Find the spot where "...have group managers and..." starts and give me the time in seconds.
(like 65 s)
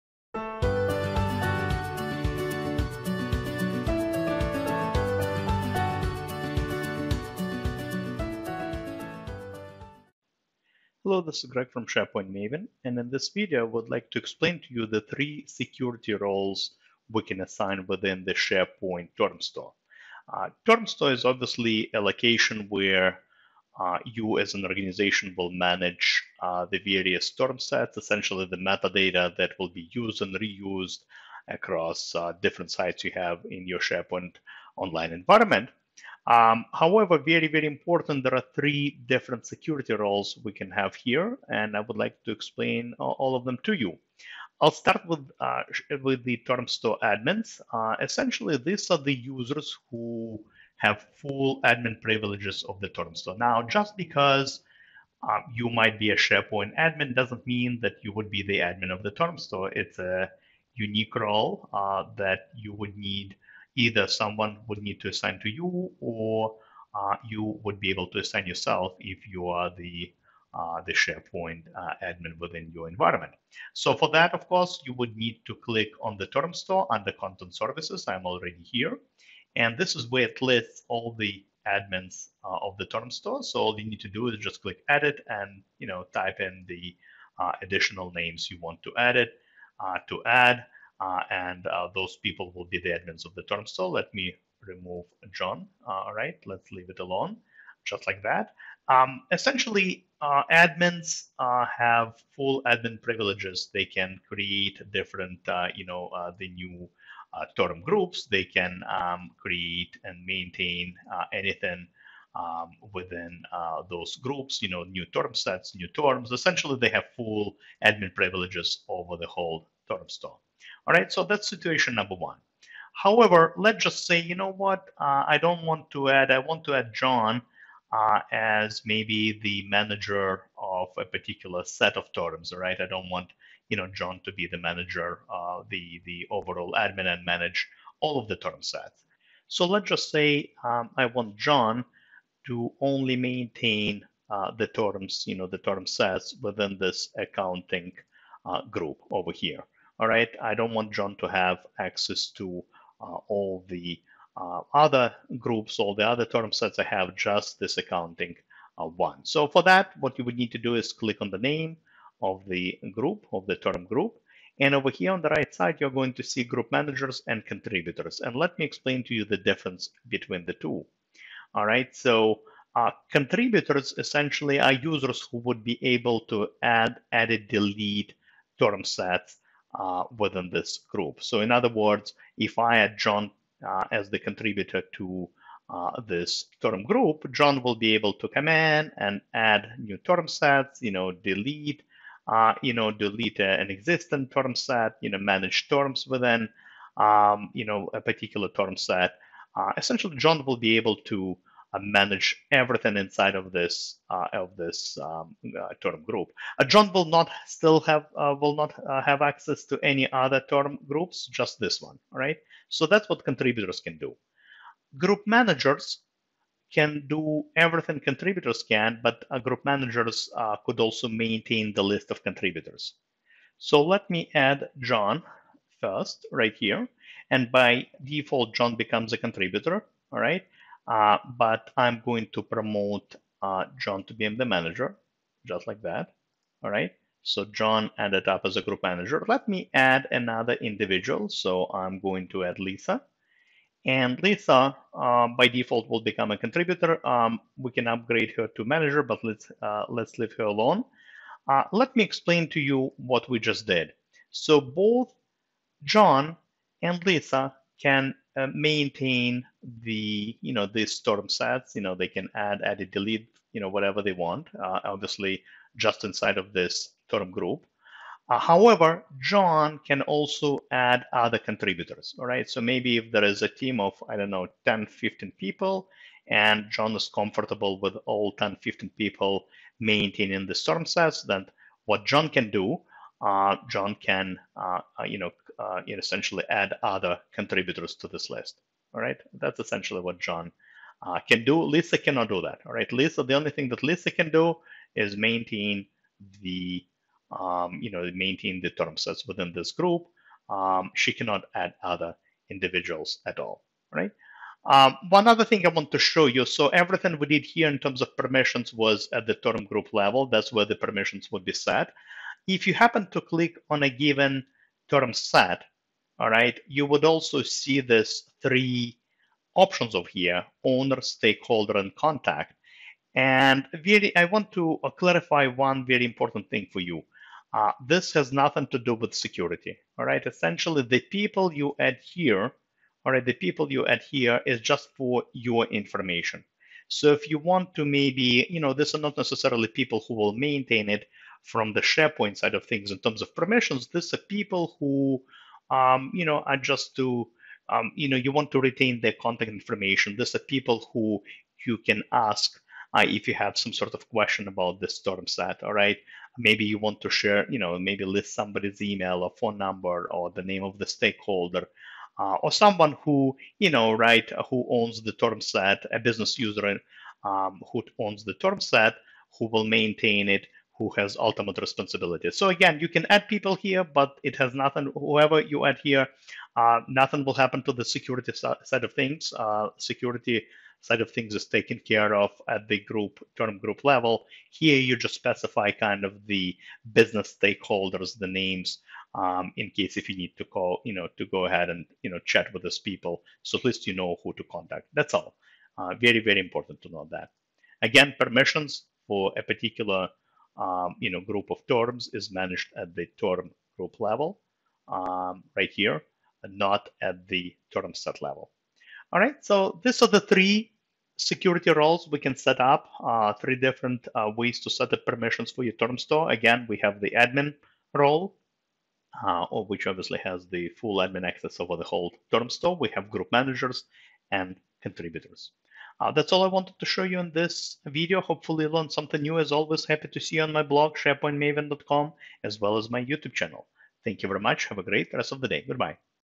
422 s.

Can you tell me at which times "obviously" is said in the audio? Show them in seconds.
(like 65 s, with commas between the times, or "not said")
21 s, 264 s, 419 s.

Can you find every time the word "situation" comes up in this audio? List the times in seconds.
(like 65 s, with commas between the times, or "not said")
121 s.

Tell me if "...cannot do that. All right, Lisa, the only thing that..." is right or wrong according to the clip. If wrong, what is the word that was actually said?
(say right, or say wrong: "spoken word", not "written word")
right.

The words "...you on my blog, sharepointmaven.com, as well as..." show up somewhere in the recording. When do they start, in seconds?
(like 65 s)
430 s.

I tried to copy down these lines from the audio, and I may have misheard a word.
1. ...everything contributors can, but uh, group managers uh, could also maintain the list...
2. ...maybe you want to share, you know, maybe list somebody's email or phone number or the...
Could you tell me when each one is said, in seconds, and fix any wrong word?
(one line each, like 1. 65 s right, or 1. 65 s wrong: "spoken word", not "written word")
1. 217 s right
2. 356 s right.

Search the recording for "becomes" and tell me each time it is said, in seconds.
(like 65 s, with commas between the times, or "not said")
228 s, 246 s.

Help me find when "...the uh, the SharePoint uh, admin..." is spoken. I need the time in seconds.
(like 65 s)
69 s.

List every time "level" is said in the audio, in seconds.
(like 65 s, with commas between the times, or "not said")
309 s, 383 s, 403 s, 408 s.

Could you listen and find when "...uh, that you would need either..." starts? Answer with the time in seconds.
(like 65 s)
61 s.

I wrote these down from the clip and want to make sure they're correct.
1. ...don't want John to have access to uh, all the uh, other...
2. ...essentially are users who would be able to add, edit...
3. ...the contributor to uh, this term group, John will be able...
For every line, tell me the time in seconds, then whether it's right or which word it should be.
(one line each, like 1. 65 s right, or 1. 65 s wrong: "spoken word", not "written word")
1. 150 s right
2. 173 s right
3. 184 s right.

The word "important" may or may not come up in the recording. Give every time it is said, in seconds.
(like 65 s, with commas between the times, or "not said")
37 s, 326 s, 396 s.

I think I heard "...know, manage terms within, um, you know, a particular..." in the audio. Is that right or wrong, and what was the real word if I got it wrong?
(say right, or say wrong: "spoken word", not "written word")
right.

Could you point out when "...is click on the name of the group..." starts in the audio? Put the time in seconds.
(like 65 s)
160 s.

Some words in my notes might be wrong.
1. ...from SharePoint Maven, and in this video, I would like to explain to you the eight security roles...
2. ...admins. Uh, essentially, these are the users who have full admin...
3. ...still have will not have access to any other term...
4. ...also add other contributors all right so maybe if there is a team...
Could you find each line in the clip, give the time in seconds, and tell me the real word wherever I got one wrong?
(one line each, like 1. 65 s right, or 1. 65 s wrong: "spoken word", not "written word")
1. 11 s wrong: "three", not "eight"
2. 47 s right
3. 207 s right
4. 270 s right.